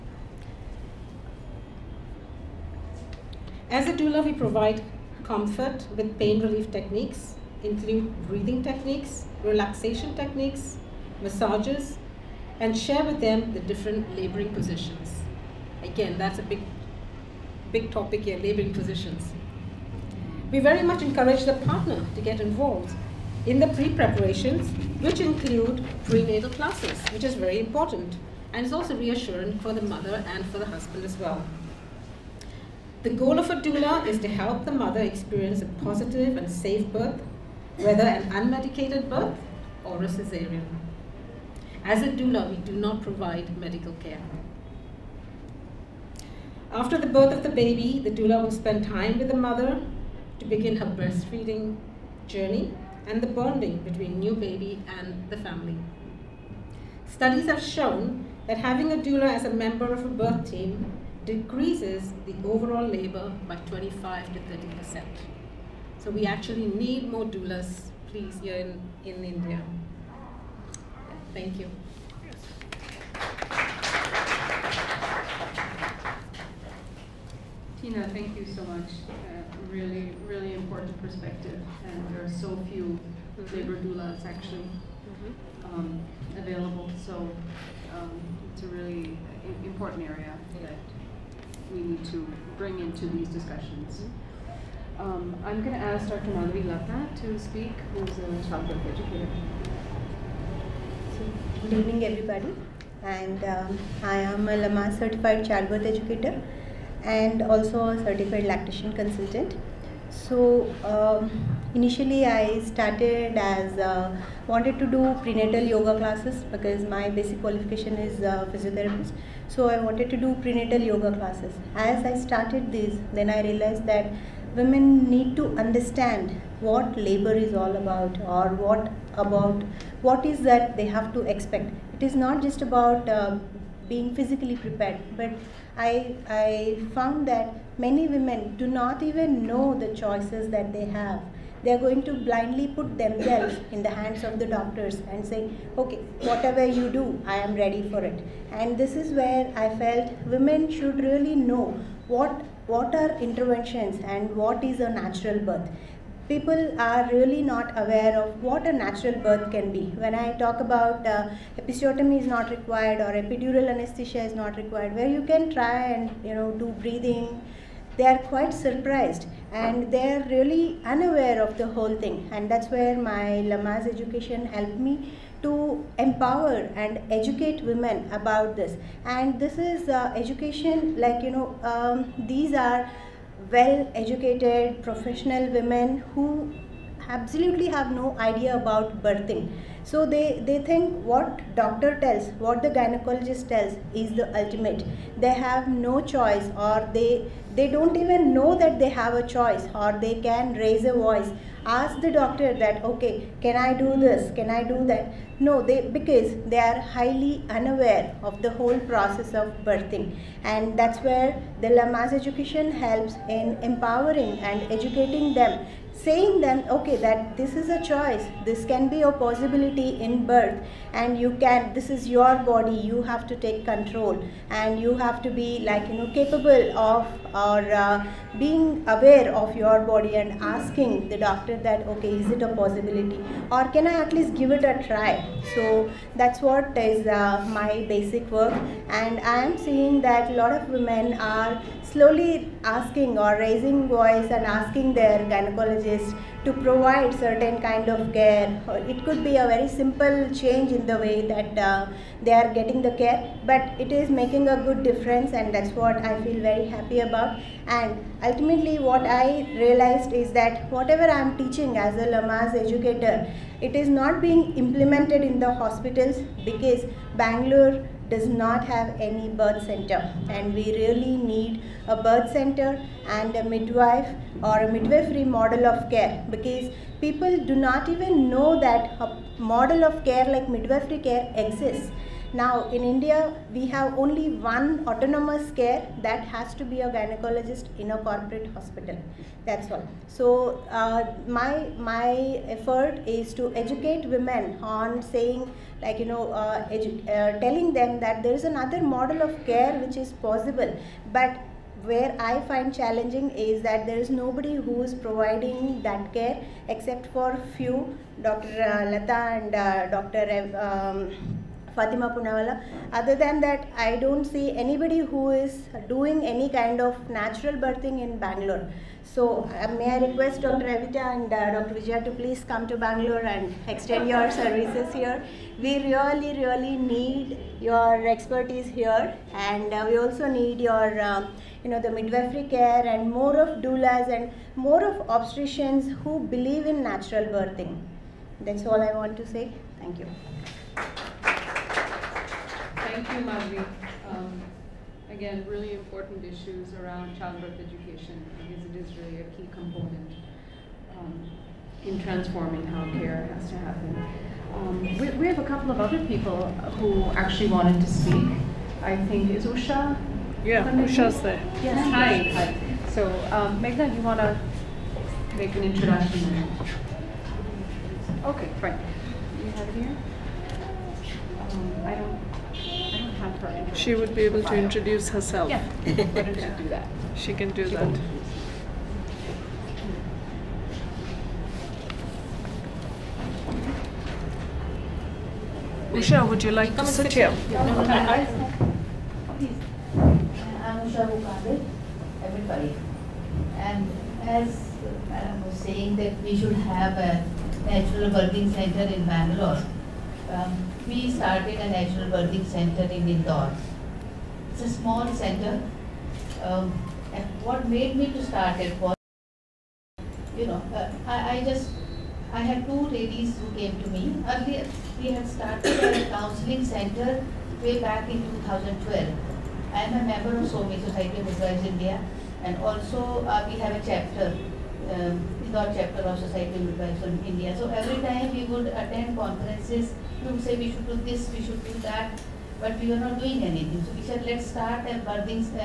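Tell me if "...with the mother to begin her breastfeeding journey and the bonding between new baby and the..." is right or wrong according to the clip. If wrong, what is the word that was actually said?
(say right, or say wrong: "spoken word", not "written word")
right.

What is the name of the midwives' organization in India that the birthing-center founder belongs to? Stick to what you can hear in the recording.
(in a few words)
SOMI.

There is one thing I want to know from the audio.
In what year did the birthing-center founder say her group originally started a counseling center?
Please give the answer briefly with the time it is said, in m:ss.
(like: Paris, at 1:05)
2012, at 6:58.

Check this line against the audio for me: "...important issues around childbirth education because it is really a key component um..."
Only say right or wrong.
right.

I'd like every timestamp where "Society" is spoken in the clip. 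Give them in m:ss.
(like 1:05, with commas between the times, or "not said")
7:00, 7:06.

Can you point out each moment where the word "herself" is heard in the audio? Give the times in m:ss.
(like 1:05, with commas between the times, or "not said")
6:15.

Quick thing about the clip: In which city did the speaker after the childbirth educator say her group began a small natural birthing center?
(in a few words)
Indore.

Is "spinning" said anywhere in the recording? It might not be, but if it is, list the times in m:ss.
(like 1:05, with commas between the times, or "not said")
not said.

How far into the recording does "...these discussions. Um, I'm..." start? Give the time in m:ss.
1:33.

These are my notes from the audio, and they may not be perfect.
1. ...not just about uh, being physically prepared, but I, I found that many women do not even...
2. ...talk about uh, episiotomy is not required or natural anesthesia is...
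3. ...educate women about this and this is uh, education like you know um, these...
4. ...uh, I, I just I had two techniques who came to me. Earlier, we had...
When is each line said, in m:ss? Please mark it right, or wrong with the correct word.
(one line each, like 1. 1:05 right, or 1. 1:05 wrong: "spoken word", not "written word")
1. 2:12 right
2. 2:40 wrong: "epidural", not "natural"
3. 2:57 right
4. 6:50 wrong: "ladies", not "techniques".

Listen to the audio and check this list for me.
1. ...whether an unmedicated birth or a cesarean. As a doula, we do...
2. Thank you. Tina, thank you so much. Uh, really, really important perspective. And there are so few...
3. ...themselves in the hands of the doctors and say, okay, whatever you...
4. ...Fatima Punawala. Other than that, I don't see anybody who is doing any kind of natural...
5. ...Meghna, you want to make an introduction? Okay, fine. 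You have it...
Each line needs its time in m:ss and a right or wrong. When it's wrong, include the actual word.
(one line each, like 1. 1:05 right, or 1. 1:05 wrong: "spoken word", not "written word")
1. 0:37 right
2. 1:11 right
3. 2:22 right
4. 5:11 right
5. 6:03 right.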